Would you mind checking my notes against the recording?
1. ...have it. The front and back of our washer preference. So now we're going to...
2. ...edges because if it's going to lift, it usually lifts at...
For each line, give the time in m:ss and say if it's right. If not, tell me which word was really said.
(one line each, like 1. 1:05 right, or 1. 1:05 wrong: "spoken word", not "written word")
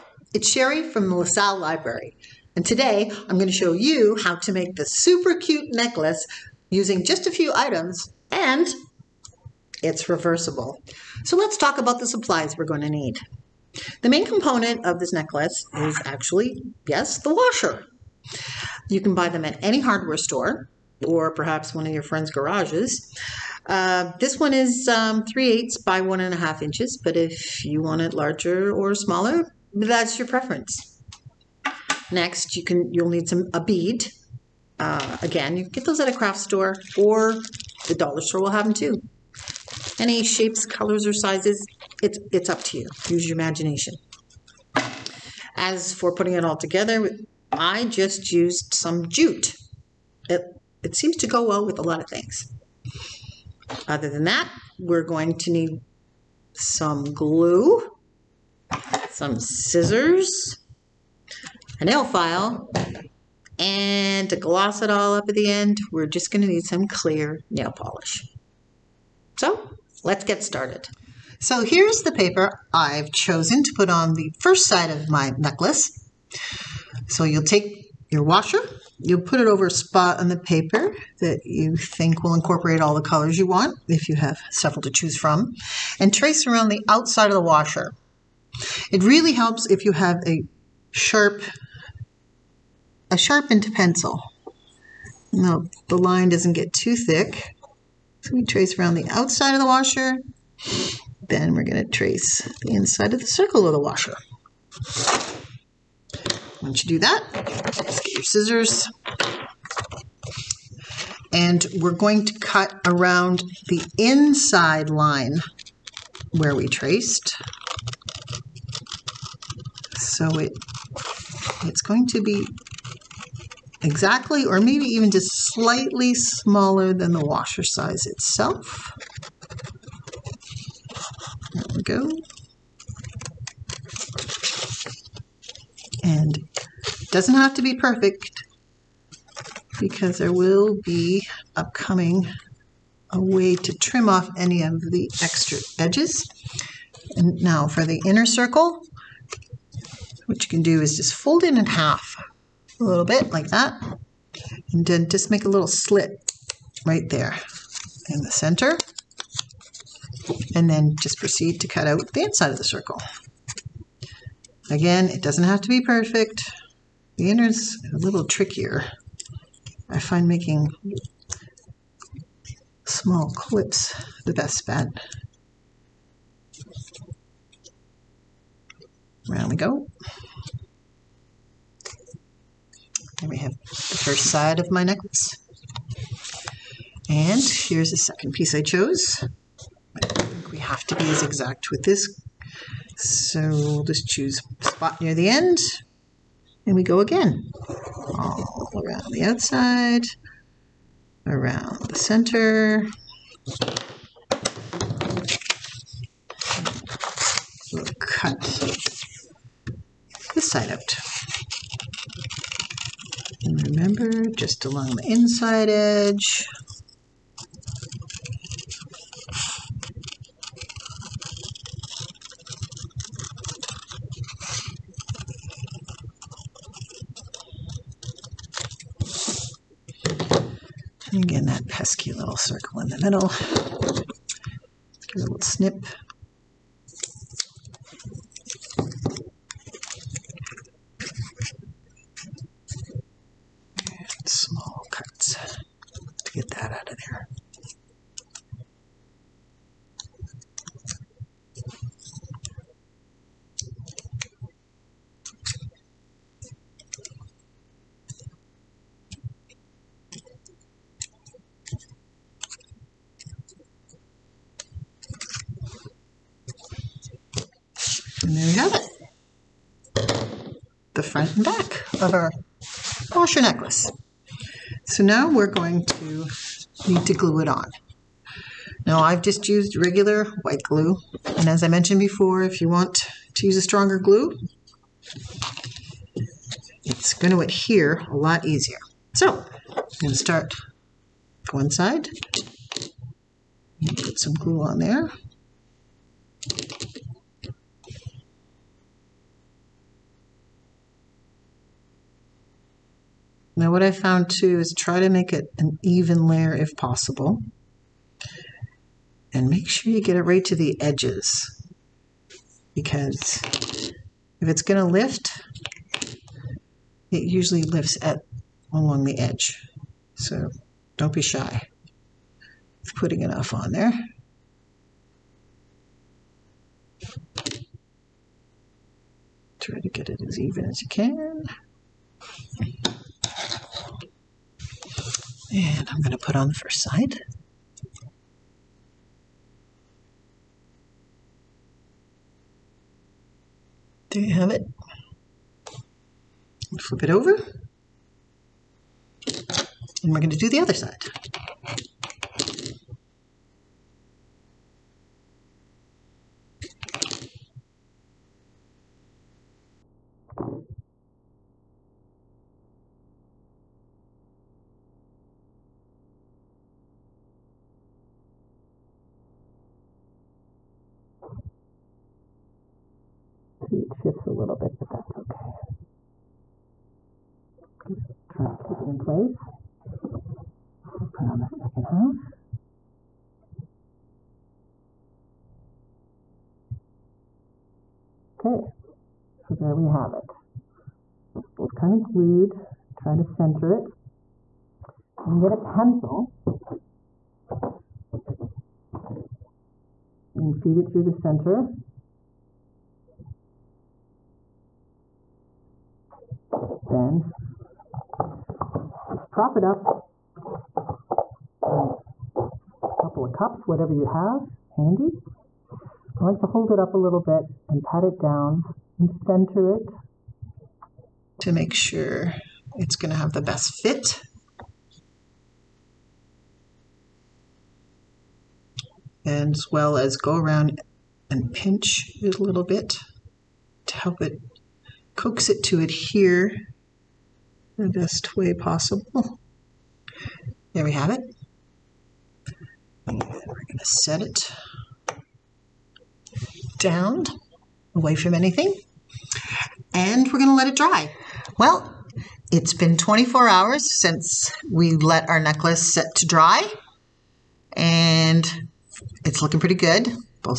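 1. 4:28 wrong: "necklace", not "preference"
2. 5:10 right.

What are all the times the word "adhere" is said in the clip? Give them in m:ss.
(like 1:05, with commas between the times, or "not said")
4:47, 7:15.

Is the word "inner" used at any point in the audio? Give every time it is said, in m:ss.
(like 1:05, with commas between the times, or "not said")
2:28, 2:47.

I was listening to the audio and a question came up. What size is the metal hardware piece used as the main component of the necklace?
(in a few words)
3/8 by 1 1/2 inches.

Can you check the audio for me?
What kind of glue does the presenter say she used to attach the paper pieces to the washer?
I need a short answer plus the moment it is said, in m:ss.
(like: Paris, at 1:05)
Regular white glue, at 4:39.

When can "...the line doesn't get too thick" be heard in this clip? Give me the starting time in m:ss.
1:35.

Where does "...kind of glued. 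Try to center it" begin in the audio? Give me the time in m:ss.
6:31.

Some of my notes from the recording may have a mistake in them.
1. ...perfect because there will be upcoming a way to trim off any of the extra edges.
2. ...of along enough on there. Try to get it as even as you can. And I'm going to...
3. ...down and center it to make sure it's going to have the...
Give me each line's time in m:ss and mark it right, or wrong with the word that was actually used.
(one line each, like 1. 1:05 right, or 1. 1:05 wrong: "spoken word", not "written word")
1. 2:17 right
2. 5:22 wrong: "putting", not "along"
3. 6:58 right.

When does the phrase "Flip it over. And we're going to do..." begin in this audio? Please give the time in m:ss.
5:46.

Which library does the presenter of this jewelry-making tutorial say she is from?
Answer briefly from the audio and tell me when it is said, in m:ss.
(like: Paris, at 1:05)
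LaSalle Library, at 0:01.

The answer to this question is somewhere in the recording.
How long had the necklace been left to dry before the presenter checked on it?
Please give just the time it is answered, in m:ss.
7:32.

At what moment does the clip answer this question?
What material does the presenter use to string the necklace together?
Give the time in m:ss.
0:49.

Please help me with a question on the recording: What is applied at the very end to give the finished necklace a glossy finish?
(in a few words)
Clear nail polish.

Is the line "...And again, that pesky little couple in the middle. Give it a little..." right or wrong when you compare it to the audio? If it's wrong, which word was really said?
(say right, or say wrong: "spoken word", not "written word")
wrong: "circle", not "couple".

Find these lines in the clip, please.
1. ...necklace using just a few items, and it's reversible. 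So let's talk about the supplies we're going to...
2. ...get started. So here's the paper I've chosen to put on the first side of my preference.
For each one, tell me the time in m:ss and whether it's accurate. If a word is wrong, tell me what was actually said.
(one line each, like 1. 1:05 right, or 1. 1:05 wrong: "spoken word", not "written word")
1. 0:05 right
2. 1:10 wrong: "necklace", not "preference".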